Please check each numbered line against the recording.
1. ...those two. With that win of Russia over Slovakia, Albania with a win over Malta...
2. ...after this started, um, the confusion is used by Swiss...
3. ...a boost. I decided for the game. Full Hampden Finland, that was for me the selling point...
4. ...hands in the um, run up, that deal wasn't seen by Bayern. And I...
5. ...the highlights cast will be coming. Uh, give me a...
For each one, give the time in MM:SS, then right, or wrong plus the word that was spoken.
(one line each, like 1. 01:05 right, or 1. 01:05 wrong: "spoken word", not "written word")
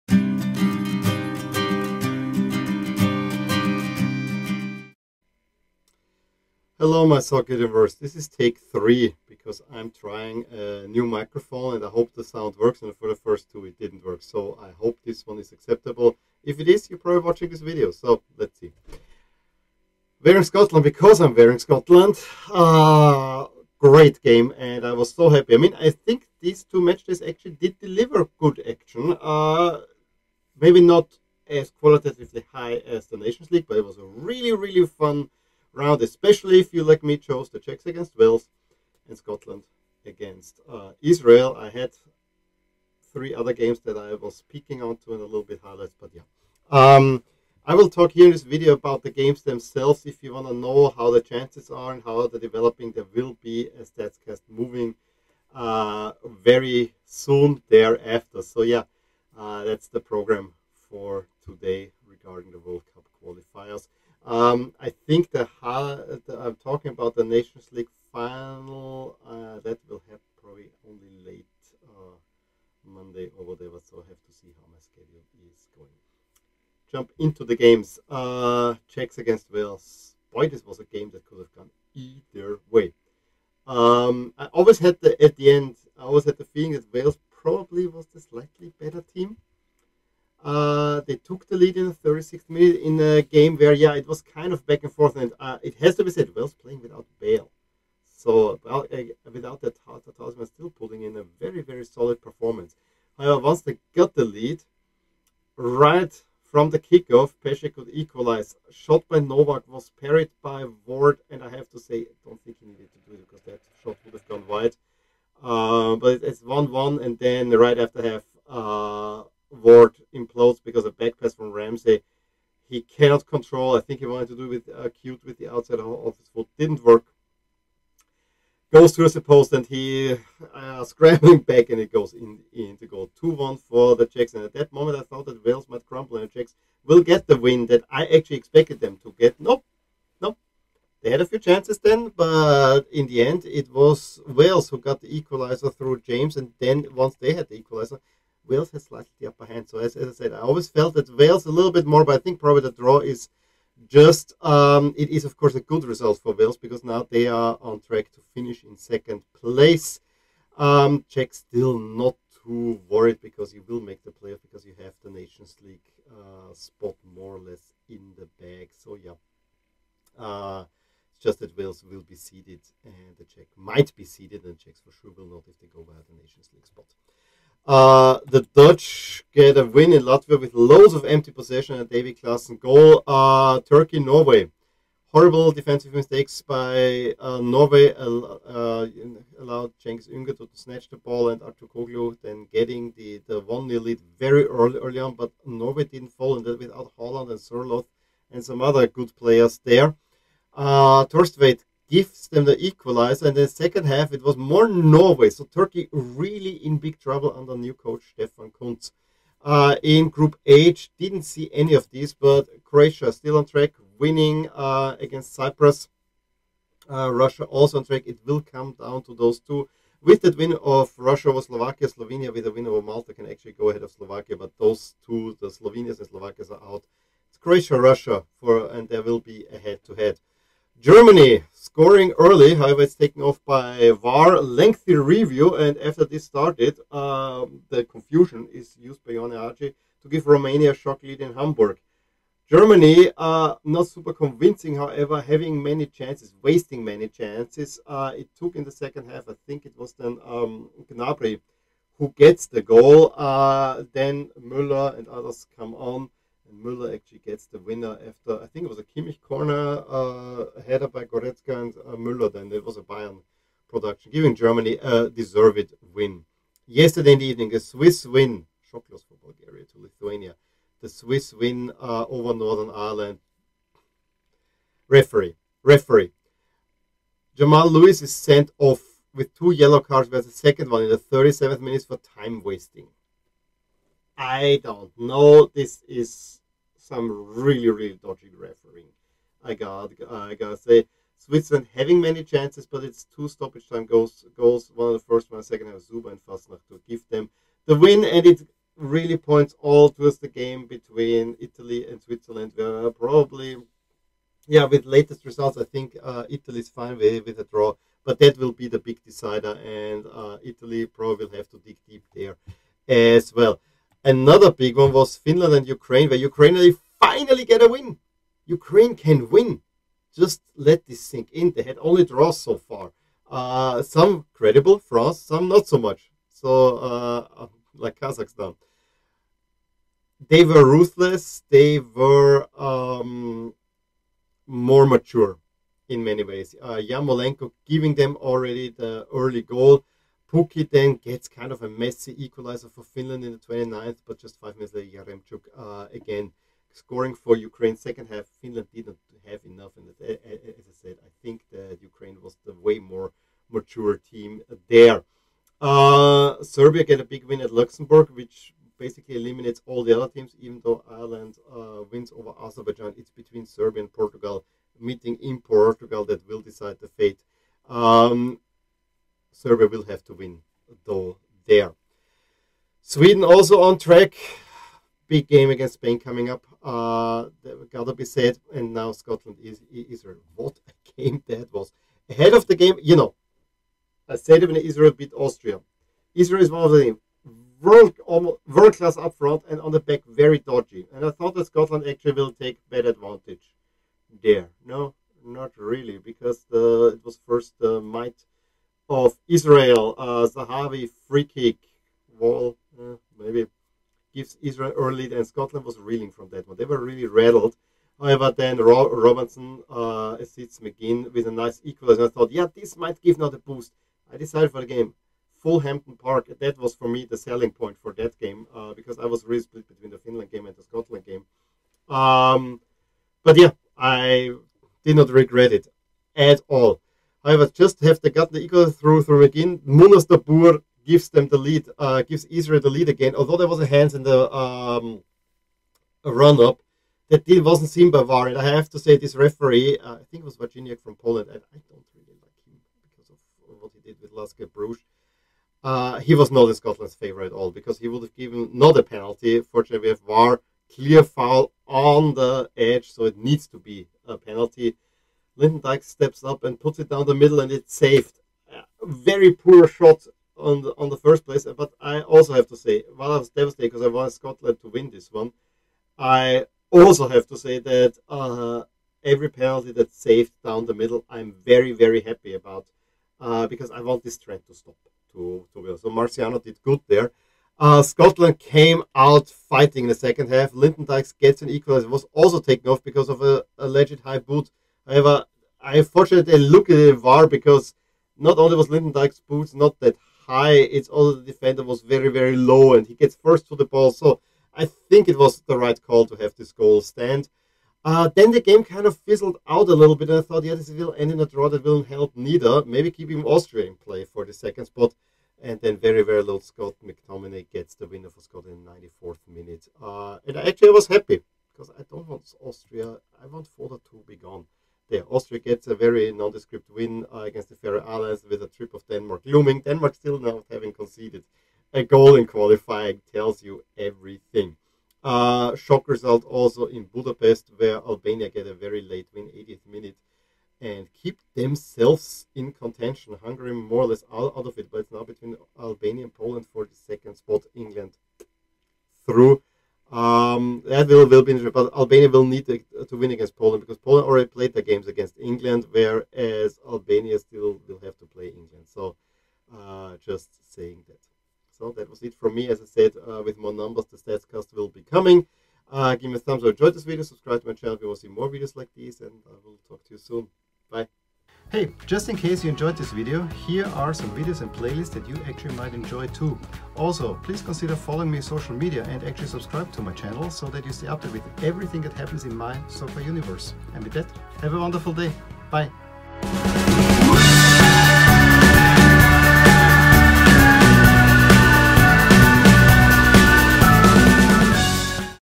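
1. 03:39 wrong: "Slovenia", not "Albania"
2. 03:55 wrong: "Ianis", not "Swiss"
3. 06:53 wrong: "Park", not "Finland"
4. 07:13 wrong: "VAR", not "Bayern"
5. 09:13 wrong: "stats", not "highlights".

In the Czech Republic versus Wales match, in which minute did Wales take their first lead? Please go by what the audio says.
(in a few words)
36th minute.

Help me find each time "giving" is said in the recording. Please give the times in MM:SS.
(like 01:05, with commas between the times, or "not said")
04:24, 05:37.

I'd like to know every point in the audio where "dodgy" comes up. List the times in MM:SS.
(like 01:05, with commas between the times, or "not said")
04:48, 06:30.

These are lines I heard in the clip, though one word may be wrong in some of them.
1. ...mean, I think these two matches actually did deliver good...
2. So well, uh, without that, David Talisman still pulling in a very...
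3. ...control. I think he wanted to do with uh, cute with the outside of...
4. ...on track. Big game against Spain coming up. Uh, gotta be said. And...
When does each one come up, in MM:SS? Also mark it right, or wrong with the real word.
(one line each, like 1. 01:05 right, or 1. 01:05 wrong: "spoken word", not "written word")
1. 00:25 right
2. 01:38 wrong: "Tata", not "David"
3. 02:03 right
4. 06:13 right.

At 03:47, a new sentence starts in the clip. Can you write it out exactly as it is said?
It's Croatia, Russia, for and there will be a head-to-head.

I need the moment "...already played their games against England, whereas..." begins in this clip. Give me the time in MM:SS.
09:04.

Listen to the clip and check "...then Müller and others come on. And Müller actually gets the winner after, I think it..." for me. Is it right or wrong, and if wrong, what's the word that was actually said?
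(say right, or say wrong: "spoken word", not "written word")
right.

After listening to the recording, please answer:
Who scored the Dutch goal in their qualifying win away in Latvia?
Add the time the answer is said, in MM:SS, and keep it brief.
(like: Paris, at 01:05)
David Klaassen, at 03:01.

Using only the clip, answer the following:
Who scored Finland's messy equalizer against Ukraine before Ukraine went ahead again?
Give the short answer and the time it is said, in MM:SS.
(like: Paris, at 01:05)
Pukki, at 05:40.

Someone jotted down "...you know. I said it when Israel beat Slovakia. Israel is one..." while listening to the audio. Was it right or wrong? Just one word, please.
wrong.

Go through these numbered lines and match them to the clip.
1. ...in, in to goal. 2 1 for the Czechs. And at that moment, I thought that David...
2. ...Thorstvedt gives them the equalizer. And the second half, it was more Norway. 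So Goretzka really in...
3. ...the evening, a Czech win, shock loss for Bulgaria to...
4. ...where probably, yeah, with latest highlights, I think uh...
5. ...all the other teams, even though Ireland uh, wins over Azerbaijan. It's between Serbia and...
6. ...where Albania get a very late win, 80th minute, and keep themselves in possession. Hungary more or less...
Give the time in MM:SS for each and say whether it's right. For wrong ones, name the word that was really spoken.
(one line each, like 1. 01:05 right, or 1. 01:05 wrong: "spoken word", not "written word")
1. 02:12 wrong: "Wales", not "David"
2. 03:21 wrong: "Turkey", not "Goretzka"
3. 04:27 wrong: "Swiss", not "Czech"
4. 05:02 wrong: "results", not "highlights"
5. 05:59 right
6. 08:47 wrong: "contention", not "possession".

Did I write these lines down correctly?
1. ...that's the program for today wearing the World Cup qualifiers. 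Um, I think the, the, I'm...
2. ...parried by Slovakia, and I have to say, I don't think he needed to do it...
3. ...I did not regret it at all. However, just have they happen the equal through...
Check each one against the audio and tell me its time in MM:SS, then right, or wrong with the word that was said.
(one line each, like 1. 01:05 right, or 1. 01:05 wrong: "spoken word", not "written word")
1. 00:59 wrong: "regarding", not "wearing"
2. 01:50 wrong: "Ward", not "Slovakia"
3. 07:03 wrong: "gotten", not "happen".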